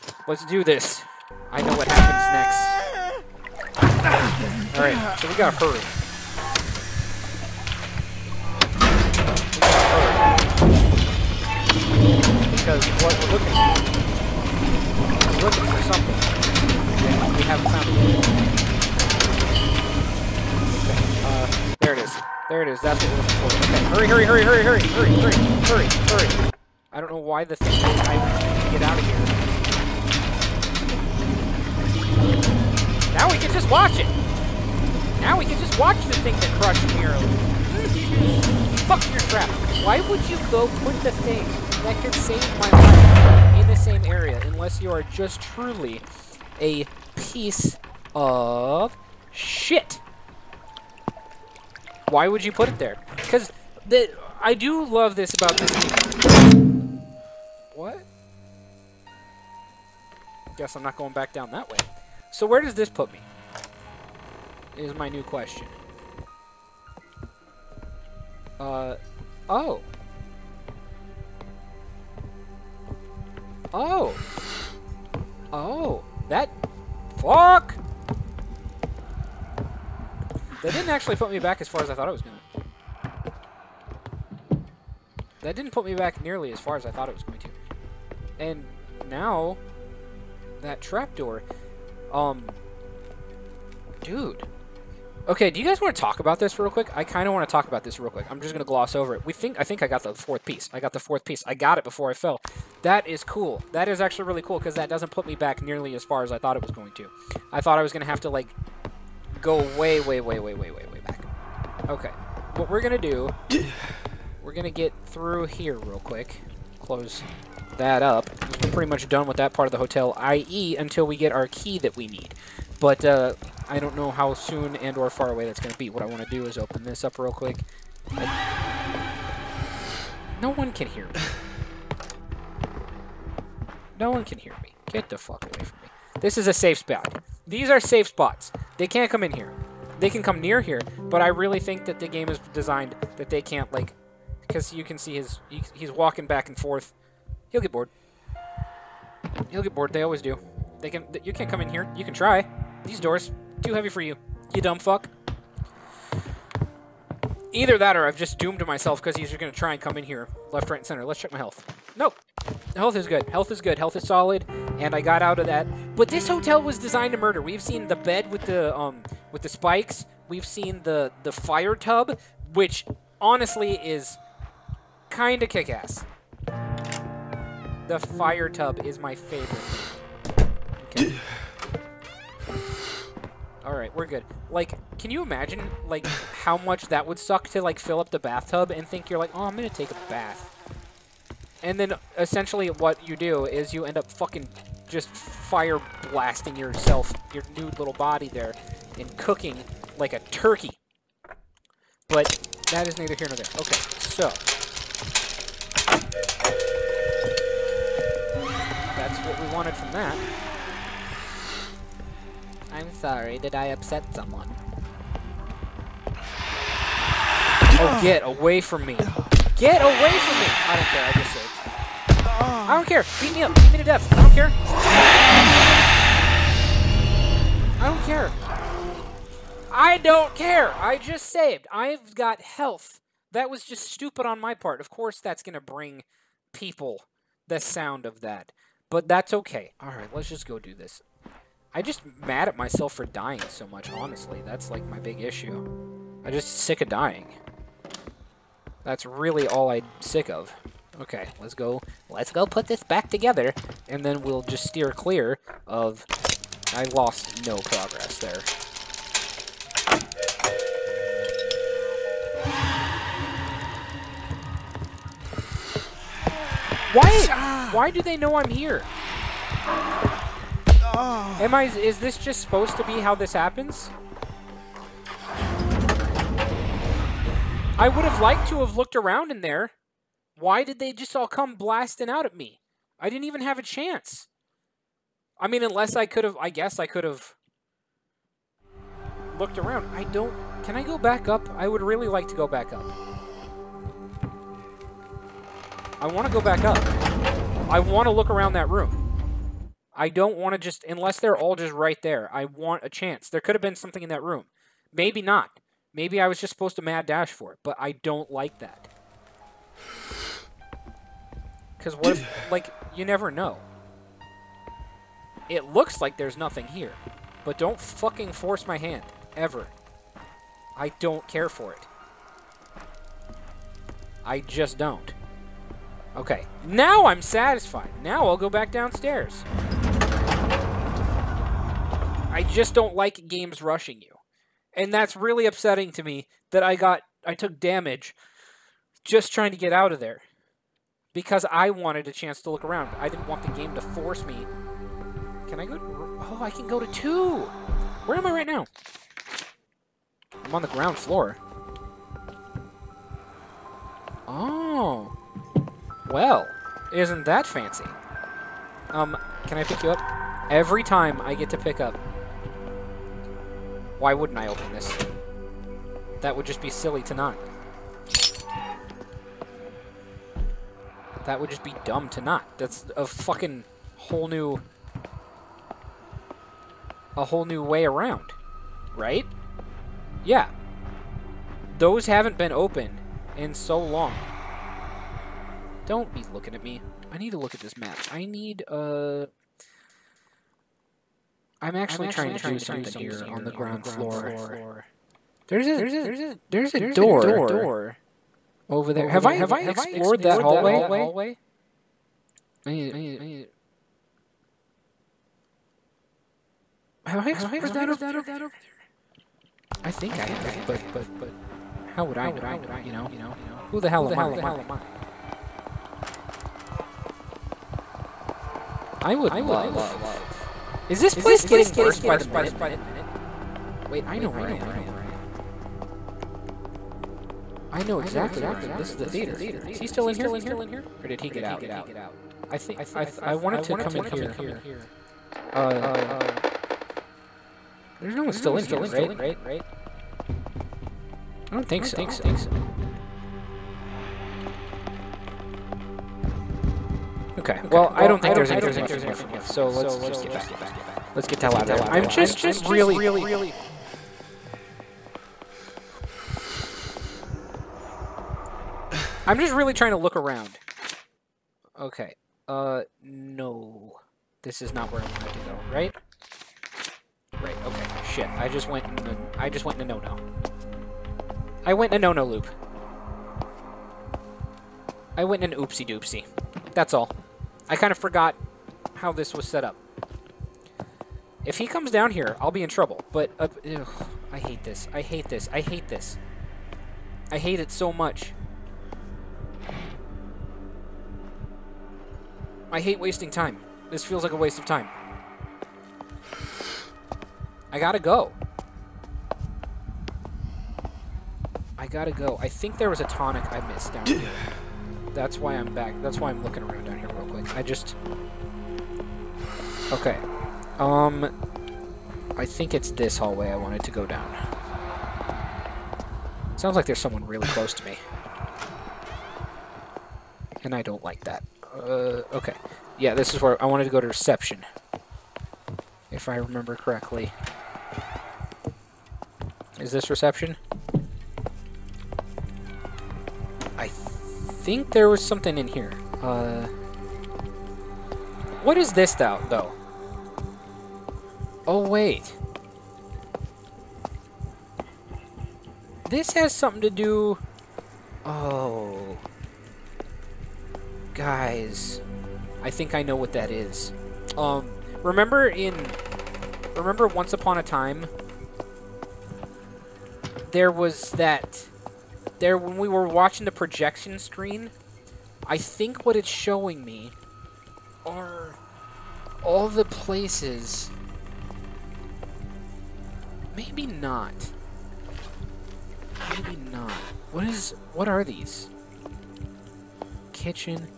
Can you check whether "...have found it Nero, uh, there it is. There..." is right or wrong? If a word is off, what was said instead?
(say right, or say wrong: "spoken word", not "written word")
wrong: "Okay", not "Nero".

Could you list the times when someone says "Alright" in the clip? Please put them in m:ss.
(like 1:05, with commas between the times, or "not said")
3:59.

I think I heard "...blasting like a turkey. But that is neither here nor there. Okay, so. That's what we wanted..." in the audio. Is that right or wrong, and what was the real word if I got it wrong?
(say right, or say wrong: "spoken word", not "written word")
wrong: "cooking", not "blasting".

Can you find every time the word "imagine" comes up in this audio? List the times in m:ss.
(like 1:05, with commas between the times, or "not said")
3:05.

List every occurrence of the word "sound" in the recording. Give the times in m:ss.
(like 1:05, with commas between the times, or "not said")
3:57, 8:36.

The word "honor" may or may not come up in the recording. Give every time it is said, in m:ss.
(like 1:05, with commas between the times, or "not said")
not said.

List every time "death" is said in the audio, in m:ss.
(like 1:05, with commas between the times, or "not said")
3:43.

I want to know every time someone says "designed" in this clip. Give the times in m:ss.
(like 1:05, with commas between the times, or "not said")
2:22, 2:46.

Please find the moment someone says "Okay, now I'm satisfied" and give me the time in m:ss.
5:26.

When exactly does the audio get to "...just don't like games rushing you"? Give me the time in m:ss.
5:32.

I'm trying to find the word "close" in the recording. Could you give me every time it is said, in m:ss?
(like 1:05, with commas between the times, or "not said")
1:56, 8:37.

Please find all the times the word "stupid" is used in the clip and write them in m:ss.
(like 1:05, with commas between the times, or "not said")
3:53.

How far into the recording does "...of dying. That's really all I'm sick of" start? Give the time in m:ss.
4:06.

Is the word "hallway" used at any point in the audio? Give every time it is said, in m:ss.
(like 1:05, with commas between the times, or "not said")
6:40, 8:33.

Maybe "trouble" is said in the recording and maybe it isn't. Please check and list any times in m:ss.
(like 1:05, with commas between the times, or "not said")
8:02.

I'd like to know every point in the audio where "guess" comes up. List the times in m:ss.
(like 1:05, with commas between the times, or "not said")
1:00, 4:46.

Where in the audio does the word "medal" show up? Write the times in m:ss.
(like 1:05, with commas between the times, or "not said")
not said.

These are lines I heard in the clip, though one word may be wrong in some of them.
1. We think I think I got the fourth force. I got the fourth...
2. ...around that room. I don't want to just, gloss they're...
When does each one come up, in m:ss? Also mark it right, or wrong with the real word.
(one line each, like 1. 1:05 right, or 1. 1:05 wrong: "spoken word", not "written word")
1. 1:39 wrong: "piece", not "force"
2. 4:58 wrong: "unless", not "gloss".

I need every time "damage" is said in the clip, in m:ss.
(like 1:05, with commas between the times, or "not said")
5:37.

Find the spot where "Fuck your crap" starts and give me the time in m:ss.
0:38.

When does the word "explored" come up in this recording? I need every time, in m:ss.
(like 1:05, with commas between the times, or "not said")
6:39, 6:47.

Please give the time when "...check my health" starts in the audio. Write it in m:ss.
2:41.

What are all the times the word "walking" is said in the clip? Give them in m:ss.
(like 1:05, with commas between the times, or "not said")
2:25.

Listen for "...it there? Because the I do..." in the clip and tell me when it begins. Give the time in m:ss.
0:52.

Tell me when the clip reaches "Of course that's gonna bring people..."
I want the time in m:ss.
3:54.